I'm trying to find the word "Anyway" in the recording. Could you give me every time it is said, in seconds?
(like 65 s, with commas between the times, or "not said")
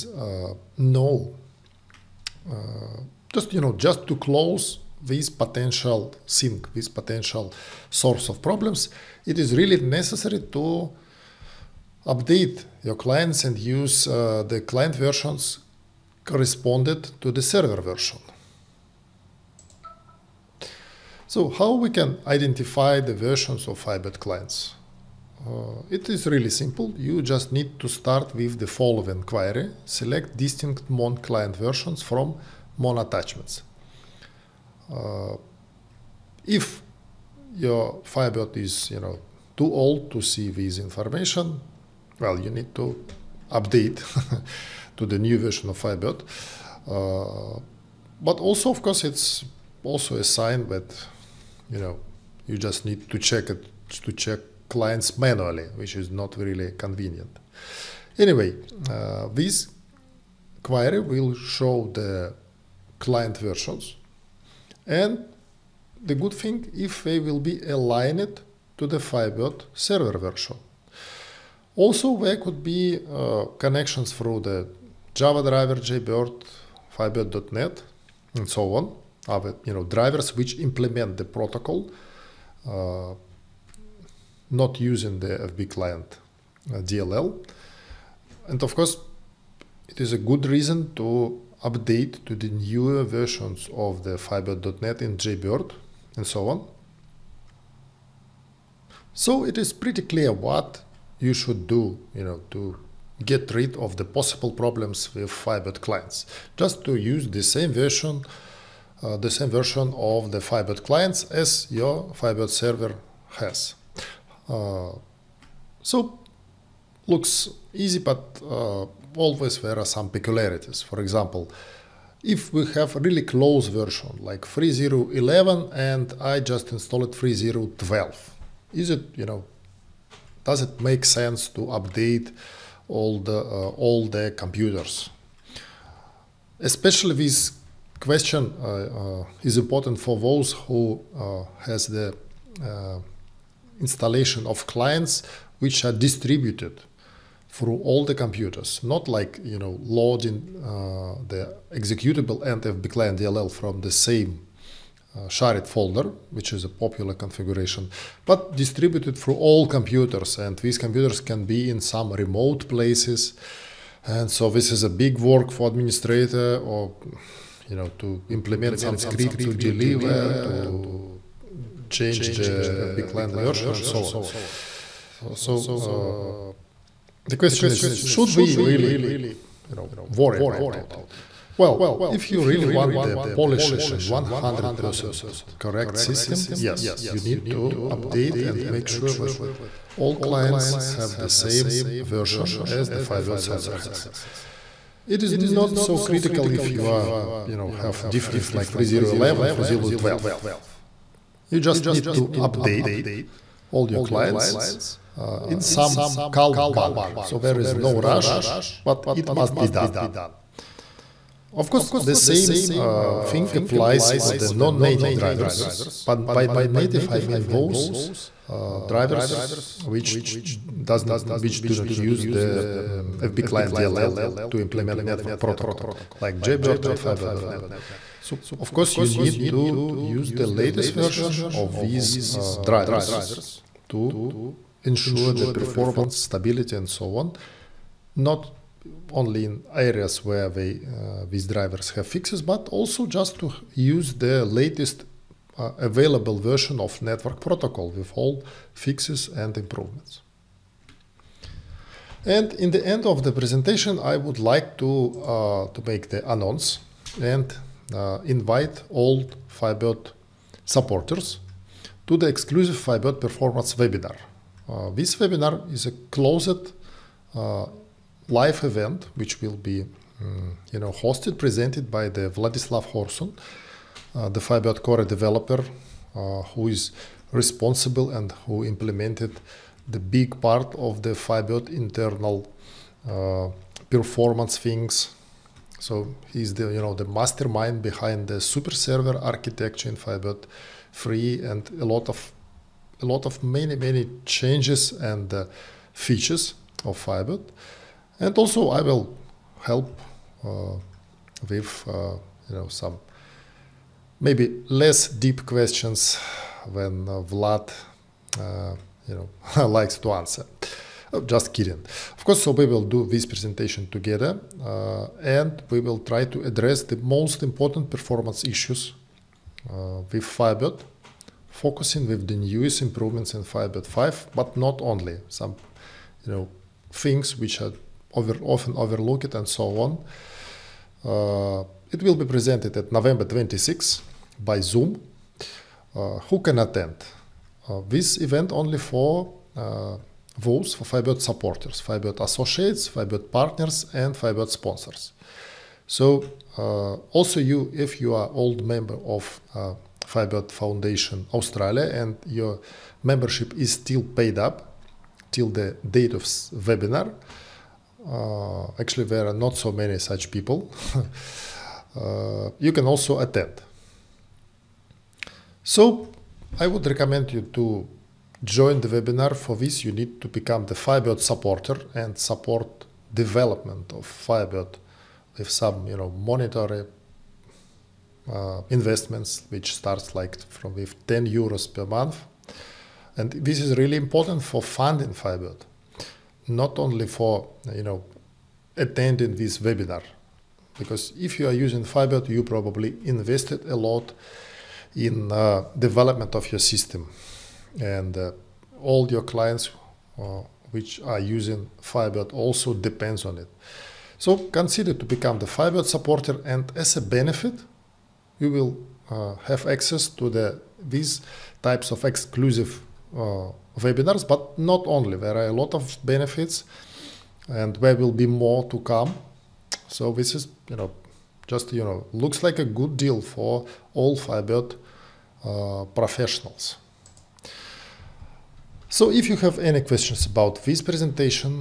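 58 s.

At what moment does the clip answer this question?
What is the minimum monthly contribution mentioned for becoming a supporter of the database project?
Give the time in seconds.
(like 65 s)
381 s.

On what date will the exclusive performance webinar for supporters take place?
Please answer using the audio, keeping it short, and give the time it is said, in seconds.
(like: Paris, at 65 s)
November 26, at 332 s.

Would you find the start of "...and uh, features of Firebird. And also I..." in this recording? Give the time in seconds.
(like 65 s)
294 s.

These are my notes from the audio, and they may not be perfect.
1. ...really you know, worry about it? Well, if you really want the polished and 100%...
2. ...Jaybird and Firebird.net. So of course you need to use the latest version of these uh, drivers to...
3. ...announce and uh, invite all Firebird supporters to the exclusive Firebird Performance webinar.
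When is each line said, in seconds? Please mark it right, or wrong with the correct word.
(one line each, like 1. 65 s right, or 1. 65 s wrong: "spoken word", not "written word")
1. 178 s right
2. 226 s right
3. 256 s right.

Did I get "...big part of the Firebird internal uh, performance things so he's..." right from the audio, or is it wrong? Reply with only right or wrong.
right.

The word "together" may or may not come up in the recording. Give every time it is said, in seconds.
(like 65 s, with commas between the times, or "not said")
313 s.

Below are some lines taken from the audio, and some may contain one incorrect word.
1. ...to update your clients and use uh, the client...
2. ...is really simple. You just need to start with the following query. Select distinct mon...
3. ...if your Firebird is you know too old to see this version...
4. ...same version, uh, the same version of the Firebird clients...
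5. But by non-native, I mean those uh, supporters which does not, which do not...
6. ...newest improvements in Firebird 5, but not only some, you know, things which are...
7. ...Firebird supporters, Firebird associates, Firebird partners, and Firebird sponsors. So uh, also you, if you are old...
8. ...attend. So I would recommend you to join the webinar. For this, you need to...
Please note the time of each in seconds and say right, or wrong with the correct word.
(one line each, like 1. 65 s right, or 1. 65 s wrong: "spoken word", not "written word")
1. 10 s right
2. 26 s right
3. 36 s wrong: "information", not "version"
4. 107 s right
5. 216 s wrong: "drivers", not "supporters"
6. 322 s right
7. 340 s right
8. 363 s right.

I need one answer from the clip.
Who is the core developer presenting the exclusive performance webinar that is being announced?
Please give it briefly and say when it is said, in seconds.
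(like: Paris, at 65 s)
Vladyslav Khorsun, at 272 s.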